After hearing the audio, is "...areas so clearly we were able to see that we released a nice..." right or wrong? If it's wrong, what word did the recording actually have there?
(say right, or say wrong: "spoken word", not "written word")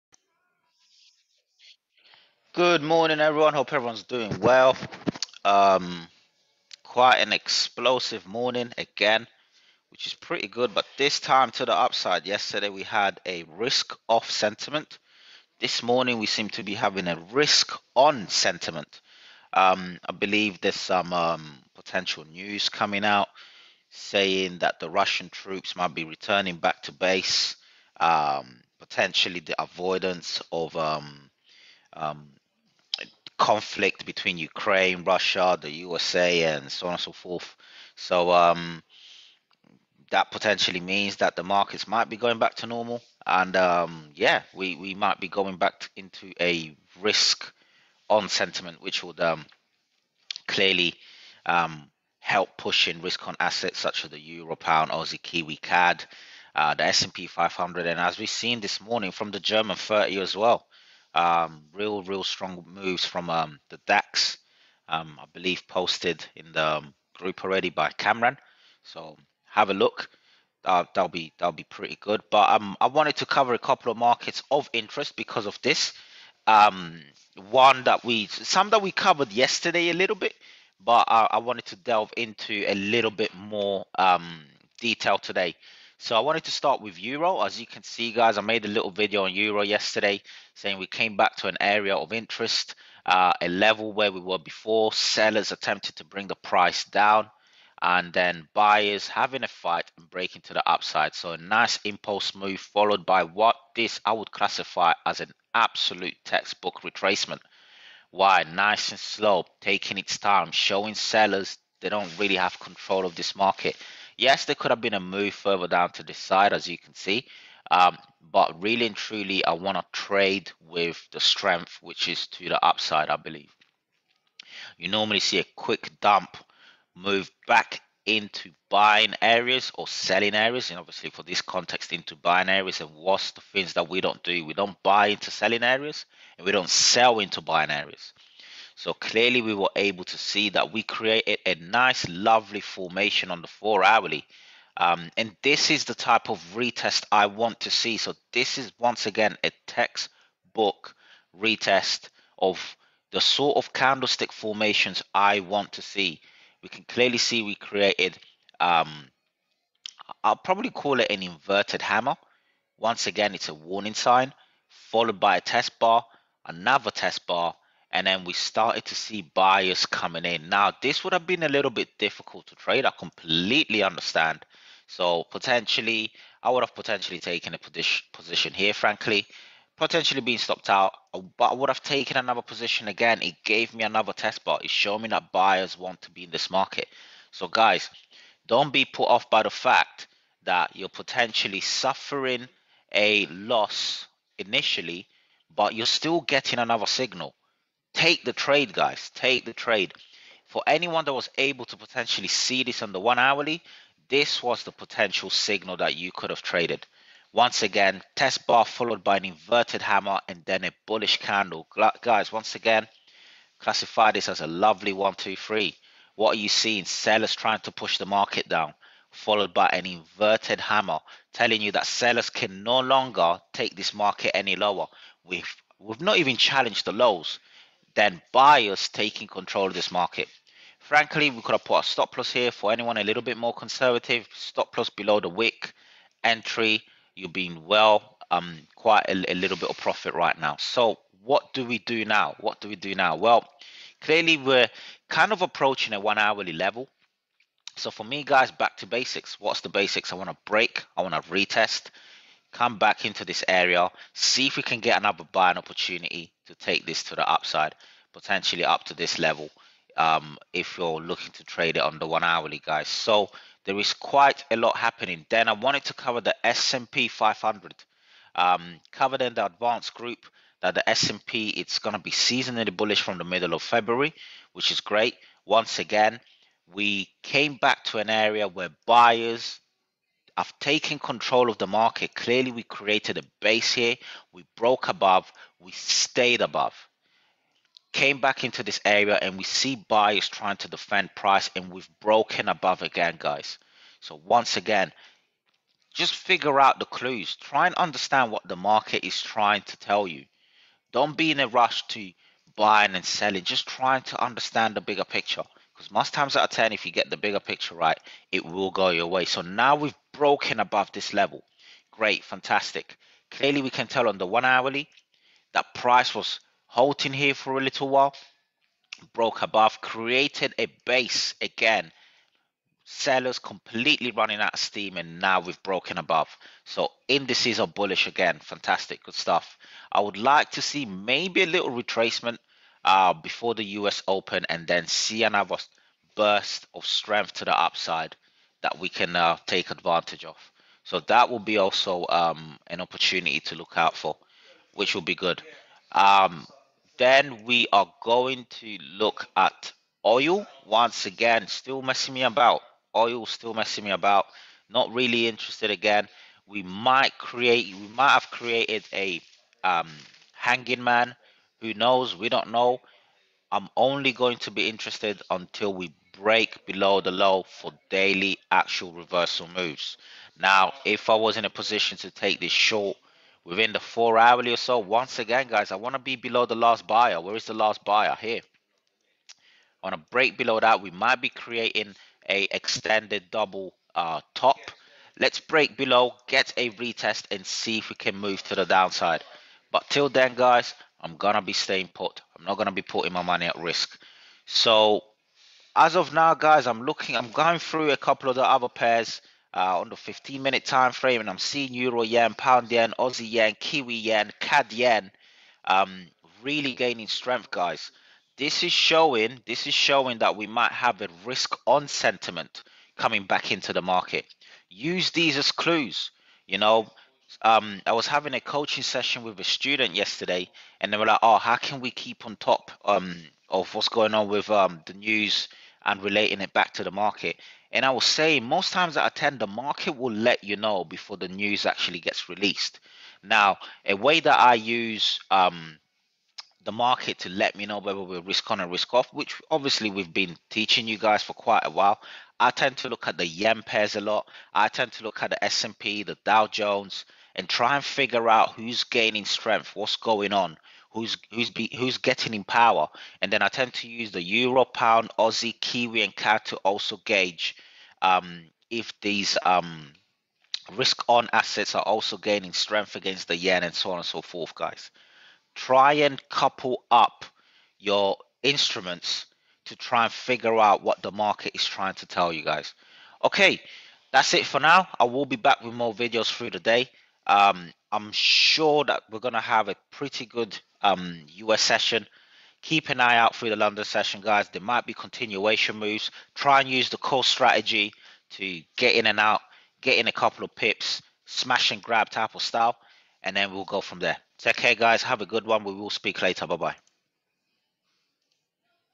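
wrong: "created", not "released".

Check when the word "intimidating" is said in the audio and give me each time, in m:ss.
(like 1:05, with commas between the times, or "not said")
not said.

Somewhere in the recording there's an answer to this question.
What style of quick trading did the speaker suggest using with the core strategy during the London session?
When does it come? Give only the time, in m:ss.
8:11.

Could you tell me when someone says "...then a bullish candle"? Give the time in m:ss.
3:30.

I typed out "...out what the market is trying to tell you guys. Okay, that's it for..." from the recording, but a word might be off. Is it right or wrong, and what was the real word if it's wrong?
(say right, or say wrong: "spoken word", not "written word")
right.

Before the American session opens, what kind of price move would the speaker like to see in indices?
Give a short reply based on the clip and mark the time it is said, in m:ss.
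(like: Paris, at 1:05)
a little retracement, at 5:31.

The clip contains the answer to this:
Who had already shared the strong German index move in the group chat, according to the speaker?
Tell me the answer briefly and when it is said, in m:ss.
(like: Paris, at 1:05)
Cameron, at 1:07.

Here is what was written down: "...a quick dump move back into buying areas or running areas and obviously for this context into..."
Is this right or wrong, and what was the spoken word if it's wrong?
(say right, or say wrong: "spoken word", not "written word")
wrong: "selling", not "running".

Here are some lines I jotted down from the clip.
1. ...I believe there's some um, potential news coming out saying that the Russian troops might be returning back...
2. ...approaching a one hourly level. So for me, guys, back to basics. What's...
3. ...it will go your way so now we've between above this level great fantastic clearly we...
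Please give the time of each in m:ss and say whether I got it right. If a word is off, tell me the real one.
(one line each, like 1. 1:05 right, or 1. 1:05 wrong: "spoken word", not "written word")
1. 0:20 right
2. 4:05 right
3. 5:08 wrong: "broken", not "between".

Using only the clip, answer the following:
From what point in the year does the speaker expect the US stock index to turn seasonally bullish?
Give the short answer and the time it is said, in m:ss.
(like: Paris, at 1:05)
middle of February, at 4:33.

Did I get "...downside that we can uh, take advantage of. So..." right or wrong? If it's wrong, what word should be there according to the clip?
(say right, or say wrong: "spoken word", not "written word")
wrong: "upside", not "downside".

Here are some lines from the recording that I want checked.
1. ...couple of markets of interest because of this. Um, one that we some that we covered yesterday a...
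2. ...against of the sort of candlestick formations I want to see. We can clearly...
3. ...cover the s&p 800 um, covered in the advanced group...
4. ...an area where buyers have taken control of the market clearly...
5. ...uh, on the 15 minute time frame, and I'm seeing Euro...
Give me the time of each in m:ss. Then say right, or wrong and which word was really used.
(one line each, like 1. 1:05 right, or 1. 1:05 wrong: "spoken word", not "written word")
1. 1:13 right
2. 2:31 wrong: "retest", not "against"
3. 4:25 wrong: "500", not "800"
4. 4:37 right
5. 6:39 right.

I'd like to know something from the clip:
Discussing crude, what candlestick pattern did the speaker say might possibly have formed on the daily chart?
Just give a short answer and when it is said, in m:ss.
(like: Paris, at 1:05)
hanging man, at 6:00.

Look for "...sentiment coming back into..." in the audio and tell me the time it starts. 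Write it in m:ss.
6:51.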